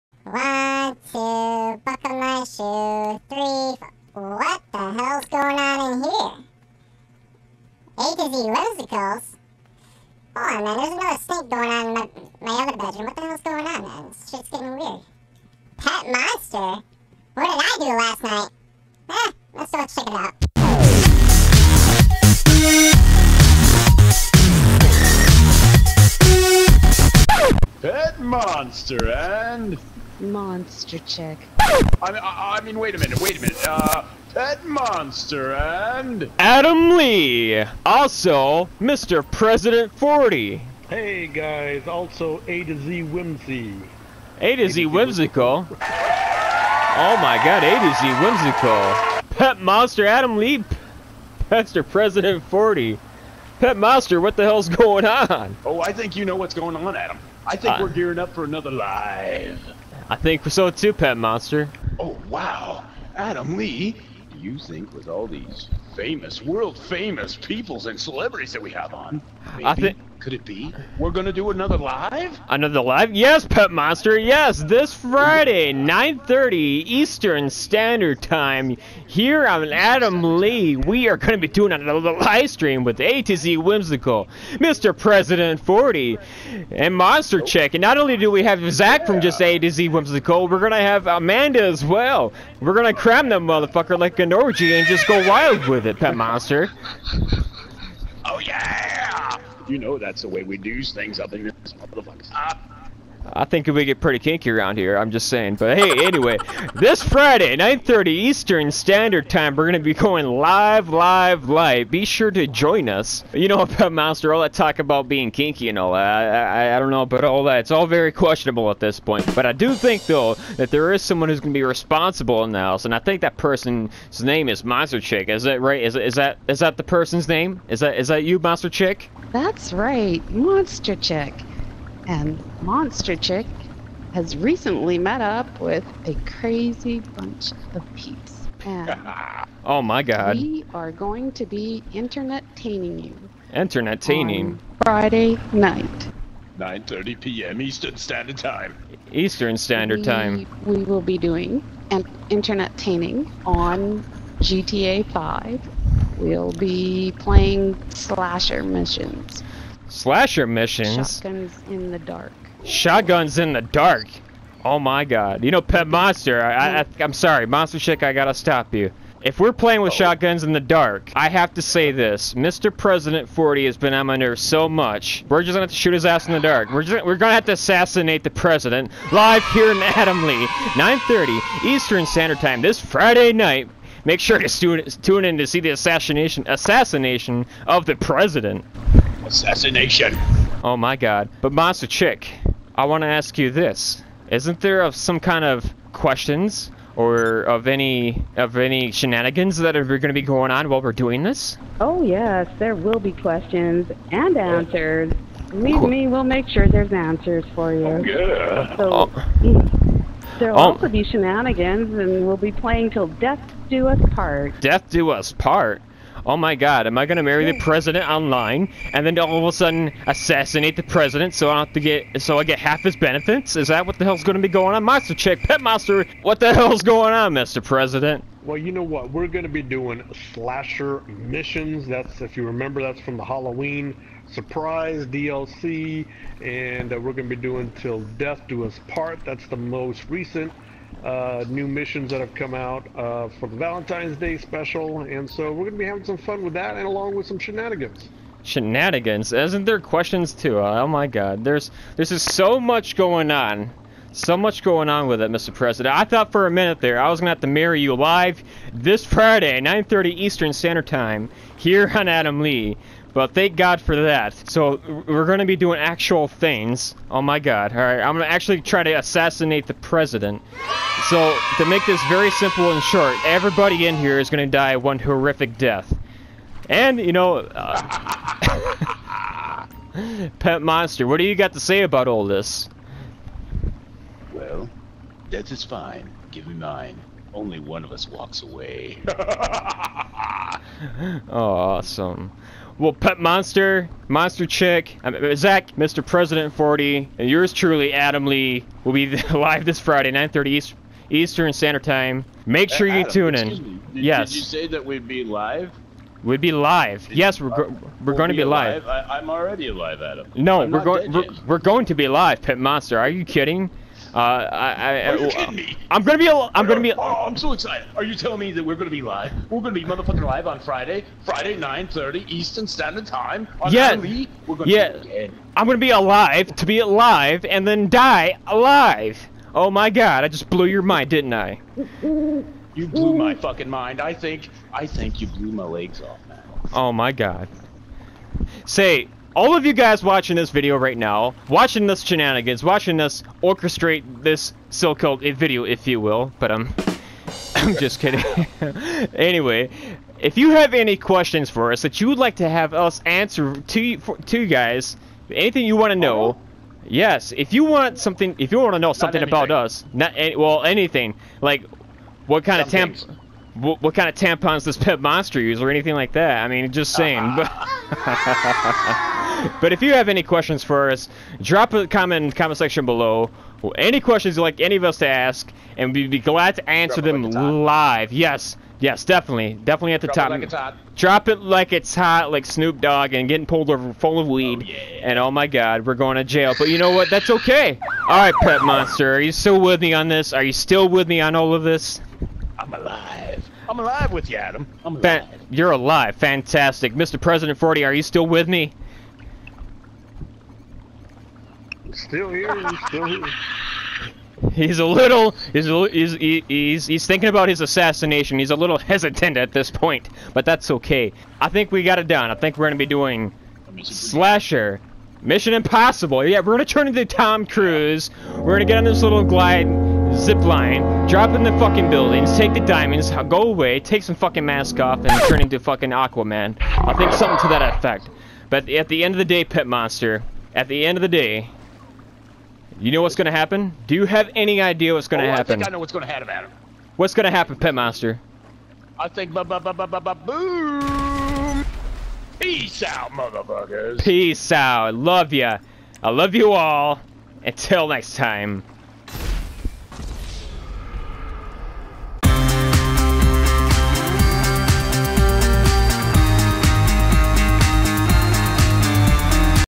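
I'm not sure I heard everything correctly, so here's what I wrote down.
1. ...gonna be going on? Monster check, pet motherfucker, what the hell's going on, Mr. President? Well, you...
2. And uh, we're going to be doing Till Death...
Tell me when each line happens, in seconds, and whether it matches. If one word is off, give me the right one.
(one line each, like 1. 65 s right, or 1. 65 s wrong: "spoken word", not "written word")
1. 224 s wrong: "monster", not "motherfucker"
2. 236 s right.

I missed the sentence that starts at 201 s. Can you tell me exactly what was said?
Oh yes, there will be questions and answers.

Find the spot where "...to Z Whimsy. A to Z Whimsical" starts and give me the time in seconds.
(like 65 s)
42 s.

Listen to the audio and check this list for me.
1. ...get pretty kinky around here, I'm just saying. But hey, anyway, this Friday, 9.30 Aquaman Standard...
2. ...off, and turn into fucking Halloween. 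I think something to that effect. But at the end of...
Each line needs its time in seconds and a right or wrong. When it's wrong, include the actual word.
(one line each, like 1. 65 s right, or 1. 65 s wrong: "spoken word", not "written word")
1. 103 s wrong: "Eastern", not "Aquaman"
2. 424 s wrong: "Aquaman", not "Halloween".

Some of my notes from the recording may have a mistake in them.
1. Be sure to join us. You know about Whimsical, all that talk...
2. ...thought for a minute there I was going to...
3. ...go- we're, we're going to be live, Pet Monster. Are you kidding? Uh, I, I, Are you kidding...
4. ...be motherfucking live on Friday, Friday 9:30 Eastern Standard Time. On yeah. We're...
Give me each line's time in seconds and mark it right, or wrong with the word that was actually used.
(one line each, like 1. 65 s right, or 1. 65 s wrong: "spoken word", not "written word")
1. 111 s wrong: "Monster", not "Whimsical"
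2. 256 s right
3. 310 s right
4. 319 s right.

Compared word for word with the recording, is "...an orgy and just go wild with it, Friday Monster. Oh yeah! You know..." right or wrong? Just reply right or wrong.
wrong.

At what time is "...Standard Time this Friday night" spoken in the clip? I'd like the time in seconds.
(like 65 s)
182 s.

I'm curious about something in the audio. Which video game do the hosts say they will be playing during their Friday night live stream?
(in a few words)
GTA 5.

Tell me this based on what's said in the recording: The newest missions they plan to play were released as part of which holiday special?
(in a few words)
Valentine's Day special.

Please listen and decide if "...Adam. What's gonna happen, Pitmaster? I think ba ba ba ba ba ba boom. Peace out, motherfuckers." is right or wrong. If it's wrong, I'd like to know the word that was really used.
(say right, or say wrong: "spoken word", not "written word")
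right.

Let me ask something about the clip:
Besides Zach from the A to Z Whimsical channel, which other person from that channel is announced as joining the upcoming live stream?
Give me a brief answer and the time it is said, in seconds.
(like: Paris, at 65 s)
Amanda, at 91 s.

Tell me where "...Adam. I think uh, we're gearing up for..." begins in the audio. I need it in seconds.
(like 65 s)
56 s.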